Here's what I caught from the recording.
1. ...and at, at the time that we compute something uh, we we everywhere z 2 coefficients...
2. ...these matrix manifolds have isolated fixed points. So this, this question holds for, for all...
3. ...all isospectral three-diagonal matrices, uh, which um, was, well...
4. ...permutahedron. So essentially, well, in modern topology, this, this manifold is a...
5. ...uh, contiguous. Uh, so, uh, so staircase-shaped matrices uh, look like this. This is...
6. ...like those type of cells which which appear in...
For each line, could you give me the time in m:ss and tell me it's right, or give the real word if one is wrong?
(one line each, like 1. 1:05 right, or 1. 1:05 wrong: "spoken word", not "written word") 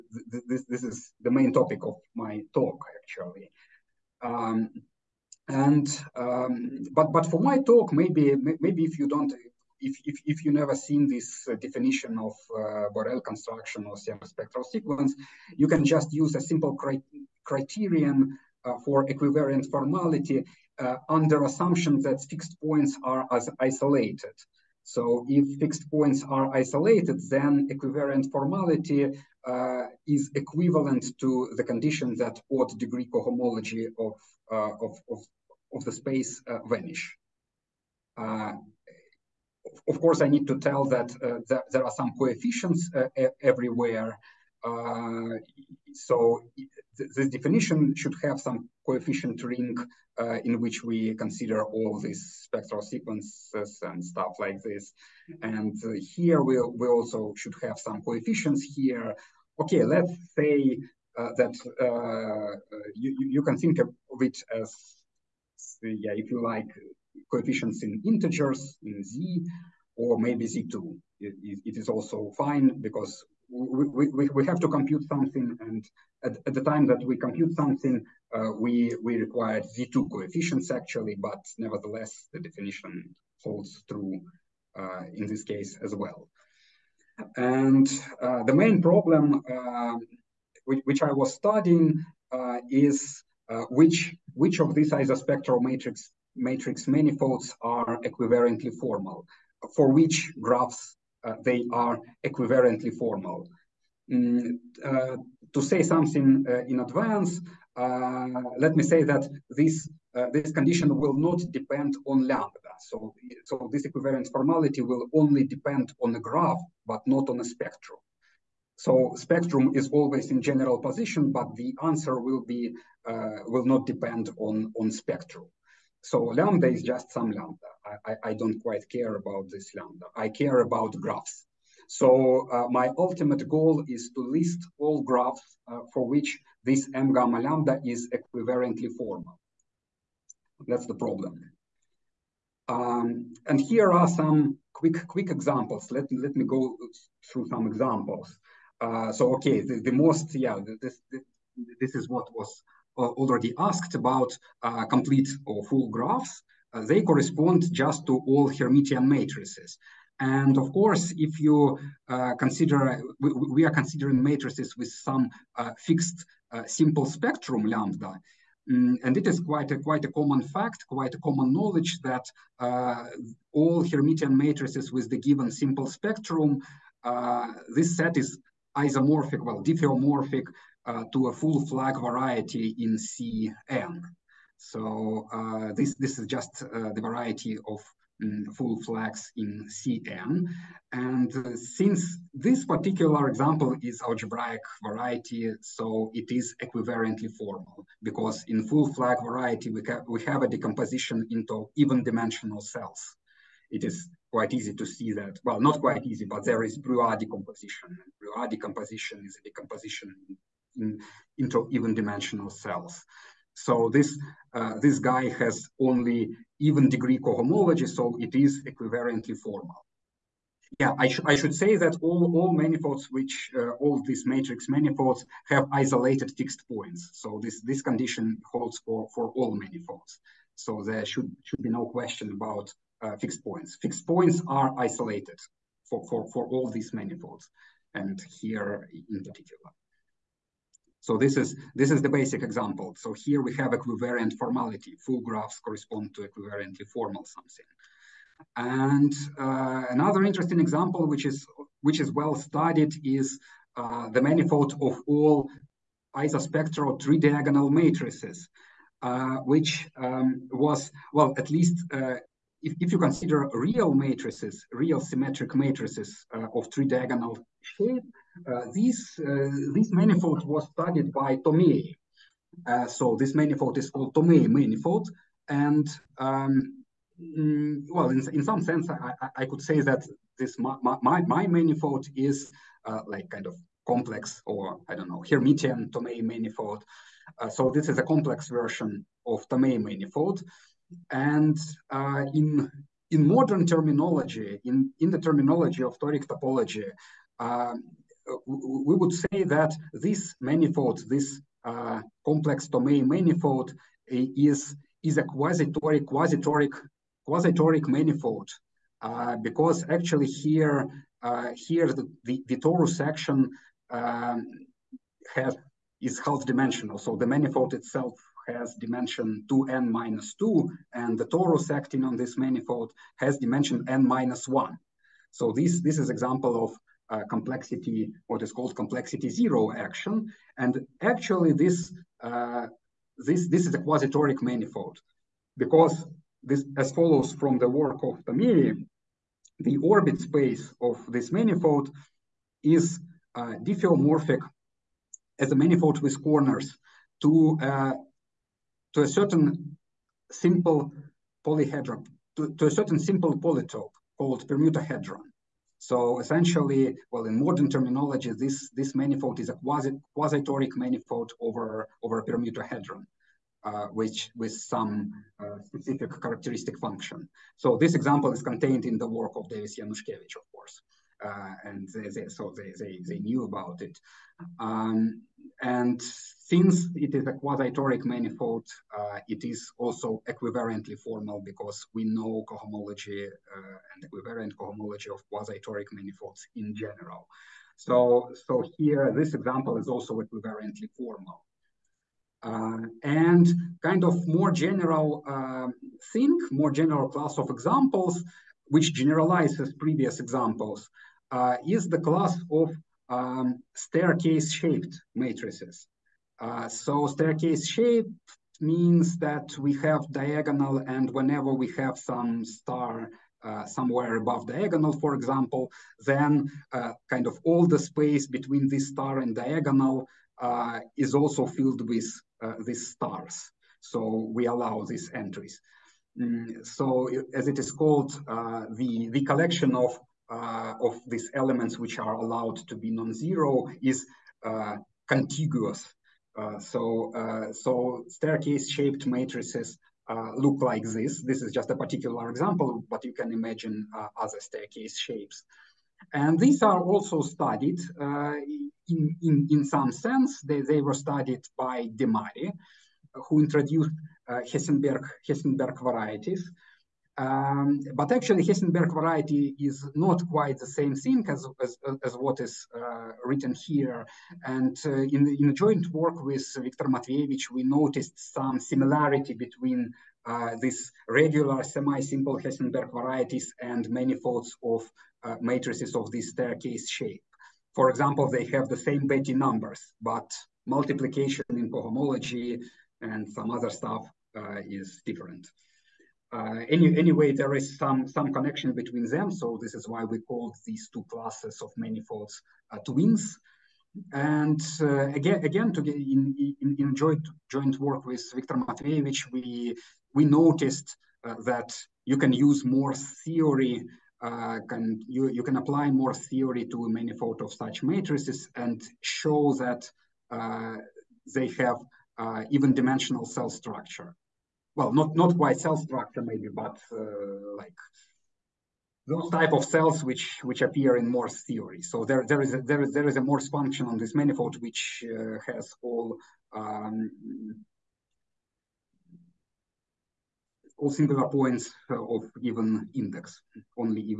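1. 1:15 wrong: "require", not "everywhere"
2. 3:44 wrong: "condition", not "question"
3. 4:15 right
4. 5:54 wrong: "terminology", not "topology"
5. 7:14 right
6. 8:37 right.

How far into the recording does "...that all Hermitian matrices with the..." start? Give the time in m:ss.
2:52.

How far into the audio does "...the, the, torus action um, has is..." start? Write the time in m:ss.
5:12.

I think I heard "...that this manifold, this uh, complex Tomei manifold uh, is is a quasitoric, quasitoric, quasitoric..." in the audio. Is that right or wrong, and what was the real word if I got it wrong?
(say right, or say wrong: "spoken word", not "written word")
right.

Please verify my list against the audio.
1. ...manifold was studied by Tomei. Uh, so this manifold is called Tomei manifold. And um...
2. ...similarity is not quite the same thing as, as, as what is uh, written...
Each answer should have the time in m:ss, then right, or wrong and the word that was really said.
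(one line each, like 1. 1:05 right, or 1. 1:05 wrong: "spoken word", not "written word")
1. 4:29 right
2. 7:38 wrong: "variety", not "similarity".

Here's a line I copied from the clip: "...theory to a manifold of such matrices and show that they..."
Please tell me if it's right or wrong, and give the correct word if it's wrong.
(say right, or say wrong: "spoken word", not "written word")
right.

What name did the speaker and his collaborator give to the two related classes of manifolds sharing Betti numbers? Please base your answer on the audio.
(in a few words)
Twins.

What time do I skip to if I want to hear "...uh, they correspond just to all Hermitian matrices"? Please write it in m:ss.
2:36.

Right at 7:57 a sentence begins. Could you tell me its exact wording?
For example, they have the same Betti numbers, but multiplication in cohomology and some other stuff uh, is different.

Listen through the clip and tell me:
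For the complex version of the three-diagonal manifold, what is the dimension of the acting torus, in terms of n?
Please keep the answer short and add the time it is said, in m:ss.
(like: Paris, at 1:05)
n minus 1, at 5:23.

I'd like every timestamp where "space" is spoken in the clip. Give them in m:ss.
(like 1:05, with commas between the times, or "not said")
0:35, 5:40, 6:57.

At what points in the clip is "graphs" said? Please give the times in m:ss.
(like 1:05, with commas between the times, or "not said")
1:40, 1:56, 2:11, 2:15, 2:35, 4:05.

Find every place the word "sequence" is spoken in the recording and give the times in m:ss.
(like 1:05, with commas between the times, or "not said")
0:14, 0:52.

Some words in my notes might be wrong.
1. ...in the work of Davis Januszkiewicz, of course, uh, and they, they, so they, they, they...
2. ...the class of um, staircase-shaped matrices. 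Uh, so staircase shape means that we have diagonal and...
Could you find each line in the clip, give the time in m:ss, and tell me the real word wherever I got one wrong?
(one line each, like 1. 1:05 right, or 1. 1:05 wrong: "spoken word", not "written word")
1. 6:08 right
2. 6:41 right.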